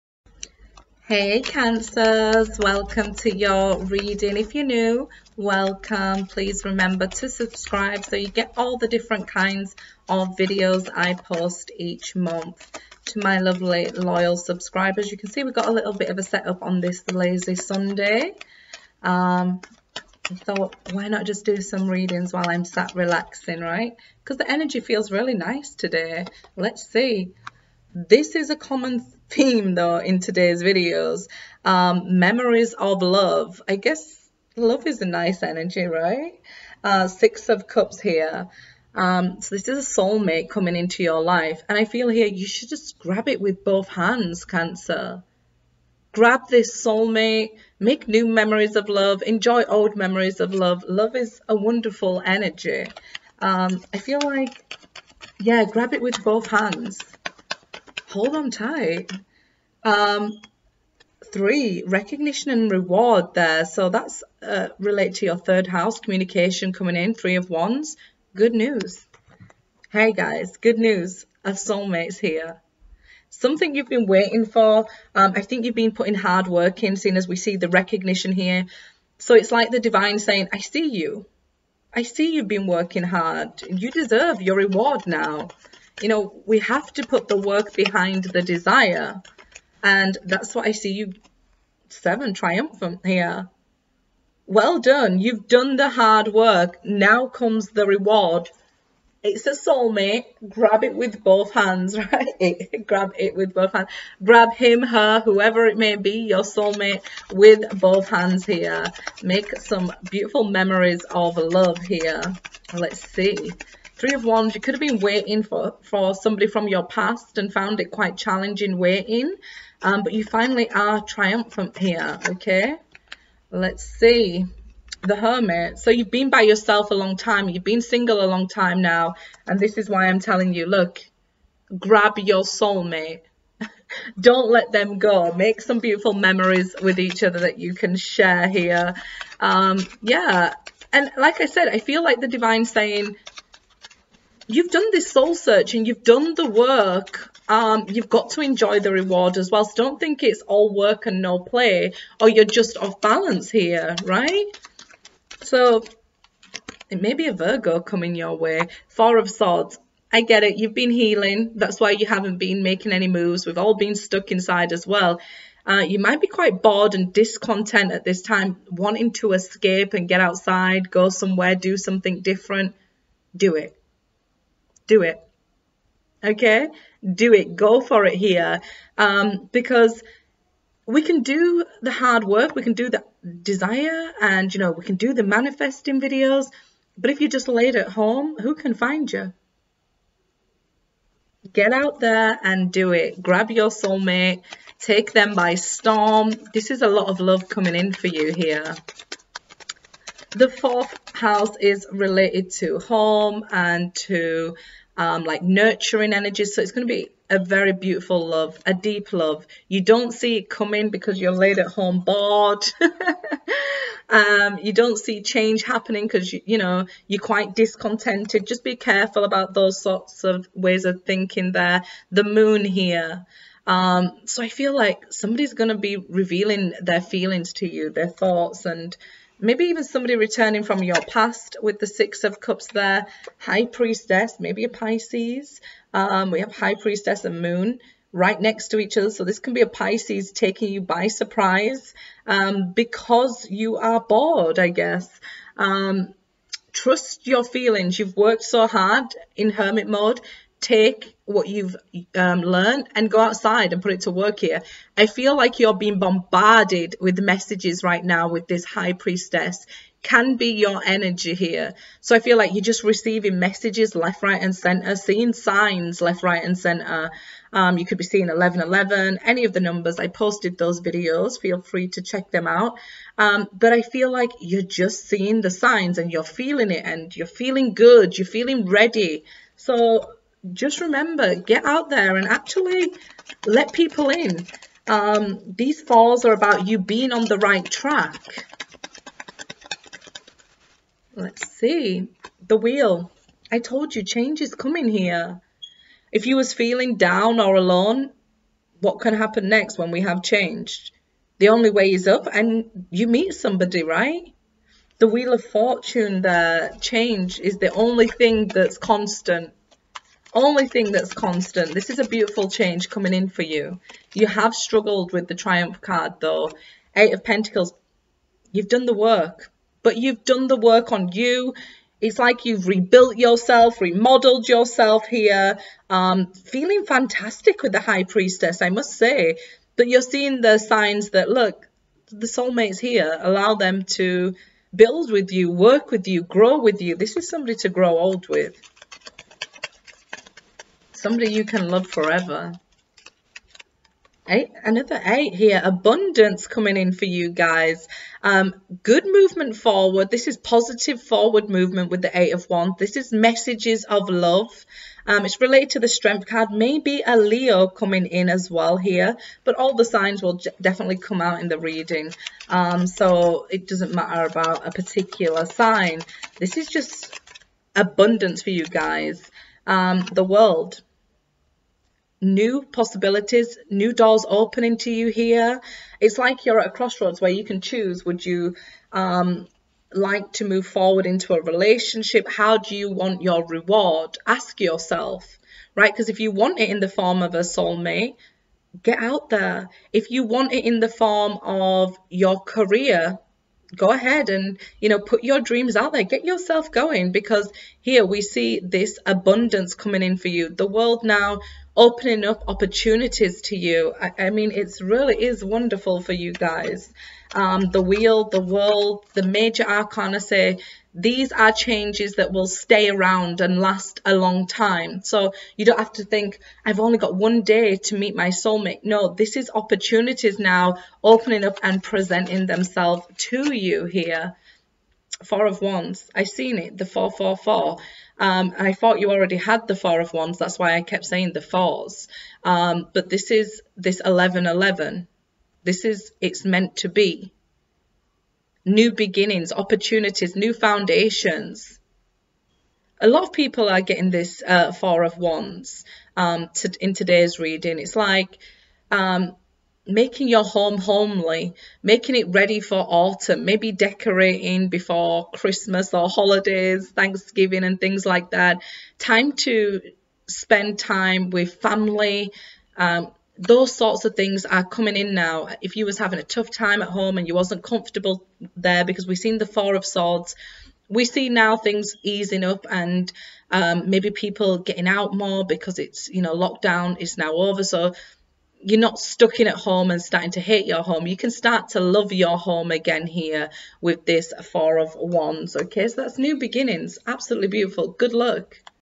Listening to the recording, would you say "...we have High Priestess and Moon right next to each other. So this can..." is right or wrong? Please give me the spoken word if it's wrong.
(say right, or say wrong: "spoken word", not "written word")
right.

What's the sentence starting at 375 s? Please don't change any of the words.
It's like you're at a crossroads where you can choose would you um, like to move forward into a relationship?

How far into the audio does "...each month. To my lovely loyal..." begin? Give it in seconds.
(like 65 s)
11 s.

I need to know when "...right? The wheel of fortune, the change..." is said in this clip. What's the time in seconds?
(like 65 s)
303 s.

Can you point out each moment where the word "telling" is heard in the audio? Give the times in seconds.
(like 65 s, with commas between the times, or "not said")
130 s.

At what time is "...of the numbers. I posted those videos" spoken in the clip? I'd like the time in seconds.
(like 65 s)
269 s.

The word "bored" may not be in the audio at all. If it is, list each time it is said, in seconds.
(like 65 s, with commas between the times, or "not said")
166 s, 212 s, 243 s.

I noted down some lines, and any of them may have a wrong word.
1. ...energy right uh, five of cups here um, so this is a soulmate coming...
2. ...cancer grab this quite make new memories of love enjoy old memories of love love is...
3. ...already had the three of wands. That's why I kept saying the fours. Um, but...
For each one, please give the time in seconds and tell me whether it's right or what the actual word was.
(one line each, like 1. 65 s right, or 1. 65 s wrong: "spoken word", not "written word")
1. 35 s wrong: "six", not "five"
2. 44 s wrong: "soulmate", not "quite"
3. 429 s wrong: "four", not "three".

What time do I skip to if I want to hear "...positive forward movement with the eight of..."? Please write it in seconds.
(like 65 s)
350 s.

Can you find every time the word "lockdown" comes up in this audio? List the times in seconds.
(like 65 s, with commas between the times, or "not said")
476 s.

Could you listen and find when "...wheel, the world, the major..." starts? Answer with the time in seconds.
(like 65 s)
407 s.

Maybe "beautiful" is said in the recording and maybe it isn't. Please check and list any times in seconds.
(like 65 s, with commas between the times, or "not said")
110 s, 135 s, 207 s, 312 s, 487 s.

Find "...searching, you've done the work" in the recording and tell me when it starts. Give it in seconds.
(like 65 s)
145 s.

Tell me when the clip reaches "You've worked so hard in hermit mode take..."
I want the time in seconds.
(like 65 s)
247 s.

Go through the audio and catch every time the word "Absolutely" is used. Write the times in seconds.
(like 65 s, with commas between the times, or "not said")
487 s.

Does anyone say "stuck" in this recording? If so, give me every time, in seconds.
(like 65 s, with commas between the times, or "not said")
163 s, 478 s.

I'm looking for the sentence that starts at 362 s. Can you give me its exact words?
Um, so it doesn't matter about a particular sign.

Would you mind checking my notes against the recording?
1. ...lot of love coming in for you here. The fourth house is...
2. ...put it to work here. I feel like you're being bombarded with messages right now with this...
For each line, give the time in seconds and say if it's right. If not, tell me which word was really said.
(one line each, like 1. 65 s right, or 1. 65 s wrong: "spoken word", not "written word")
1. 196 s right
2. 253 s right.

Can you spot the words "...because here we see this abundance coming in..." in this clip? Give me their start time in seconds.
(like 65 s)
397 s.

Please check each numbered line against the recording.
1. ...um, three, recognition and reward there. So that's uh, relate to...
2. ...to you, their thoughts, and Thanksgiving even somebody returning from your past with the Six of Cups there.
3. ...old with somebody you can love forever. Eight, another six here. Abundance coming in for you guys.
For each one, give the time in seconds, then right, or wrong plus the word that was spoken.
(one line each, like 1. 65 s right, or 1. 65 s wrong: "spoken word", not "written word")
1. 59 s right
2. 227 s wrong: "Maybe", not "Thanksgiving"
3. 337 s wrong: "eight", not "six".